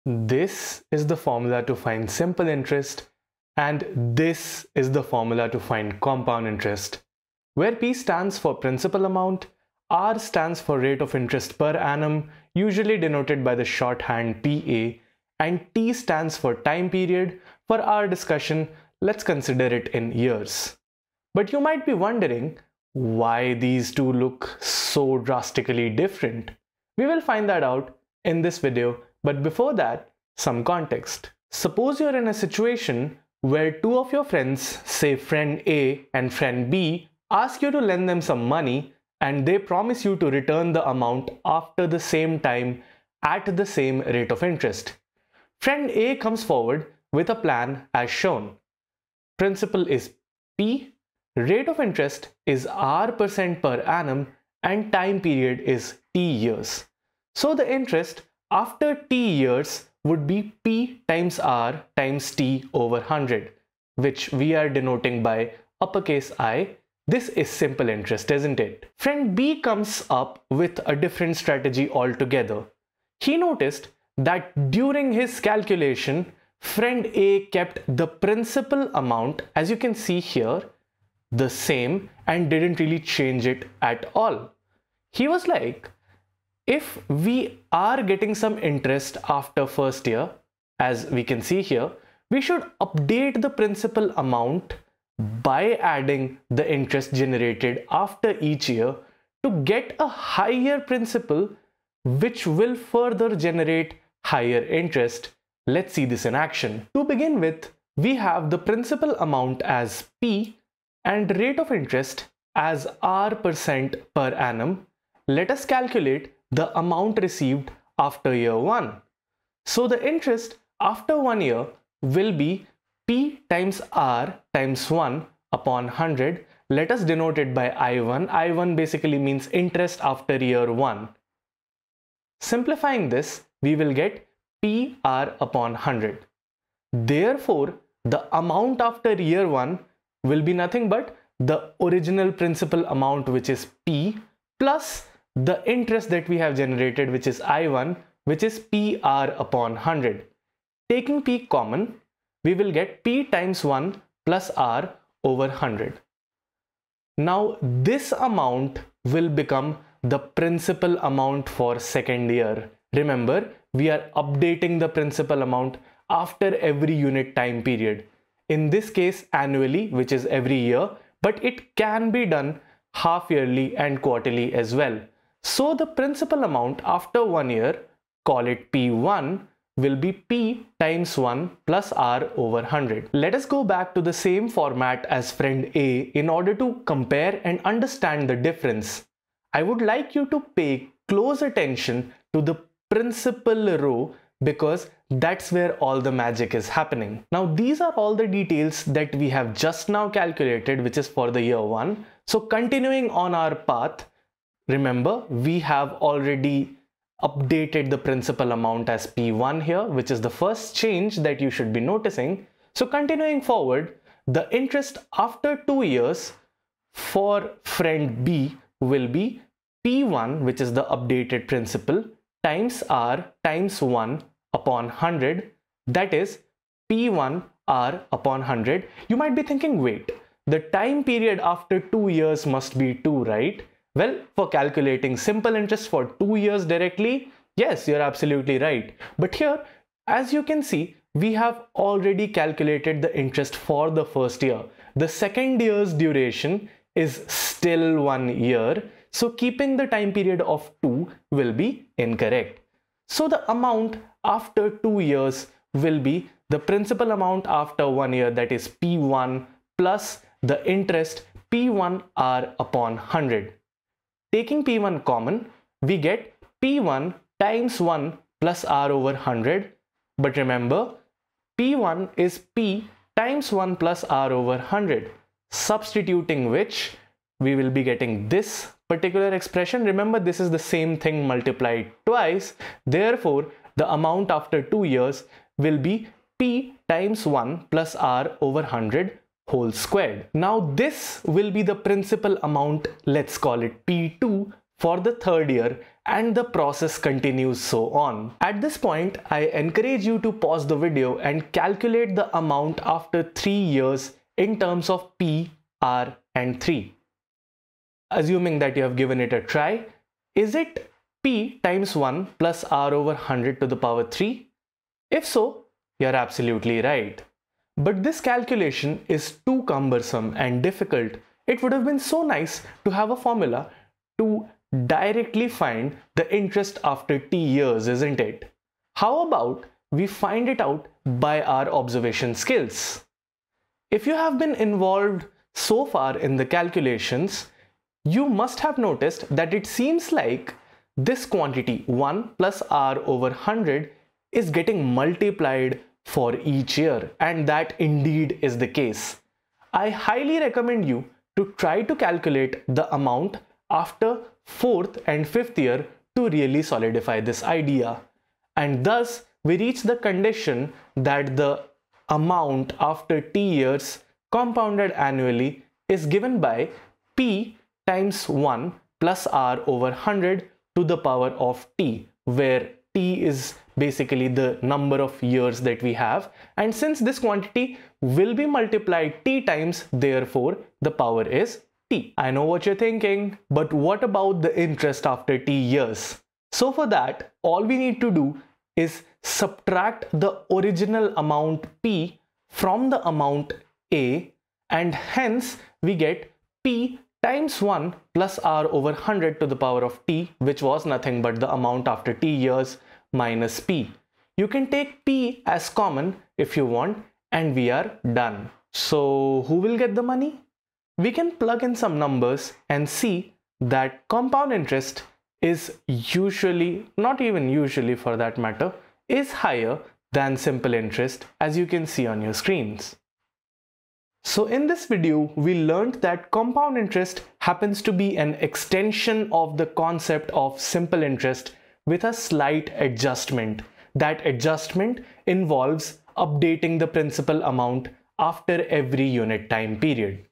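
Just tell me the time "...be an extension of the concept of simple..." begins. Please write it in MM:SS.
07:07.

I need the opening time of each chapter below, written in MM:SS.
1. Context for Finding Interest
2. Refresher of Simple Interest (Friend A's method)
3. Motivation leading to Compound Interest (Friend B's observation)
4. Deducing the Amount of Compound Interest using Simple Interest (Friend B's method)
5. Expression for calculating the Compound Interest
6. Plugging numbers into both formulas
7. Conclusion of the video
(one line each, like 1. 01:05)
1. 00:31
2. 00:45
3. 01:12
4. 01:47
5. 06:22
6. 06:50
7. 07:03.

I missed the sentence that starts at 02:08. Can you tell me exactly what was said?
I1 basically means interest after year 1.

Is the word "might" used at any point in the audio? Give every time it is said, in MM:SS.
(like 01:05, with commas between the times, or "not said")
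00:21, 03:49.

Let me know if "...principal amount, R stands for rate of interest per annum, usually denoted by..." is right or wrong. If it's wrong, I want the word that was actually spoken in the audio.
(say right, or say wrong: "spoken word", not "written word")
right.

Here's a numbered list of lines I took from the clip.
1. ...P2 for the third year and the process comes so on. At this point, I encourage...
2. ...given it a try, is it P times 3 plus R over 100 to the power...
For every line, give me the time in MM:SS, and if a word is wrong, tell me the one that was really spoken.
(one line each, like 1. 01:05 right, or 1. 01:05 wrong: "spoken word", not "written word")
1. 04:53 wrong: "continues", not "comes"
2. 05:08 wrong: "1", not "3".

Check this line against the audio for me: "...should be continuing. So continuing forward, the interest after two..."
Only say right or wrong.
wrong.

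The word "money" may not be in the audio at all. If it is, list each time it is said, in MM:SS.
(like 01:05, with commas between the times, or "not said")
00:38, 06:50.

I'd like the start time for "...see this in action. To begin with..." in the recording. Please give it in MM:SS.
01:45.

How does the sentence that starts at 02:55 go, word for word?
So the principal amount after one year, call it P1, will be P times 1 plus R over 100.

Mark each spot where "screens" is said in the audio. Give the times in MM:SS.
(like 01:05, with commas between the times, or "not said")
07:02.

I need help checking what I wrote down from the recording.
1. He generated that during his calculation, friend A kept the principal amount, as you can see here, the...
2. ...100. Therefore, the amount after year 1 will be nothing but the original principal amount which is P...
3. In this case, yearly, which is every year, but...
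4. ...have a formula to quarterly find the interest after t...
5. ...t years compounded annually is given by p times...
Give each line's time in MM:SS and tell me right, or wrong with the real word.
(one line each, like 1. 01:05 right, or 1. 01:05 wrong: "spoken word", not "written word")
1. 01:13 wrong: "noticed", not "generated"
2. 02:15 right
3. 02:48 wrong: "annually", not "yearly"
4. 05:22 wrong: "directly", not "quarterly"
5. 06:03 right.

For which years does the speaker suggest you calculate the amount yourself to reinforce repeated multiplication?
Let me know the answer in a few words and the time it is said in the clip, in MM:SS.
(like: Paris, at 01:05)
4th and 5th, at 05:54.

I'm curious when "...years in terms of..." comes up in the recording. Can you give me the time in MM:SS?
05:03.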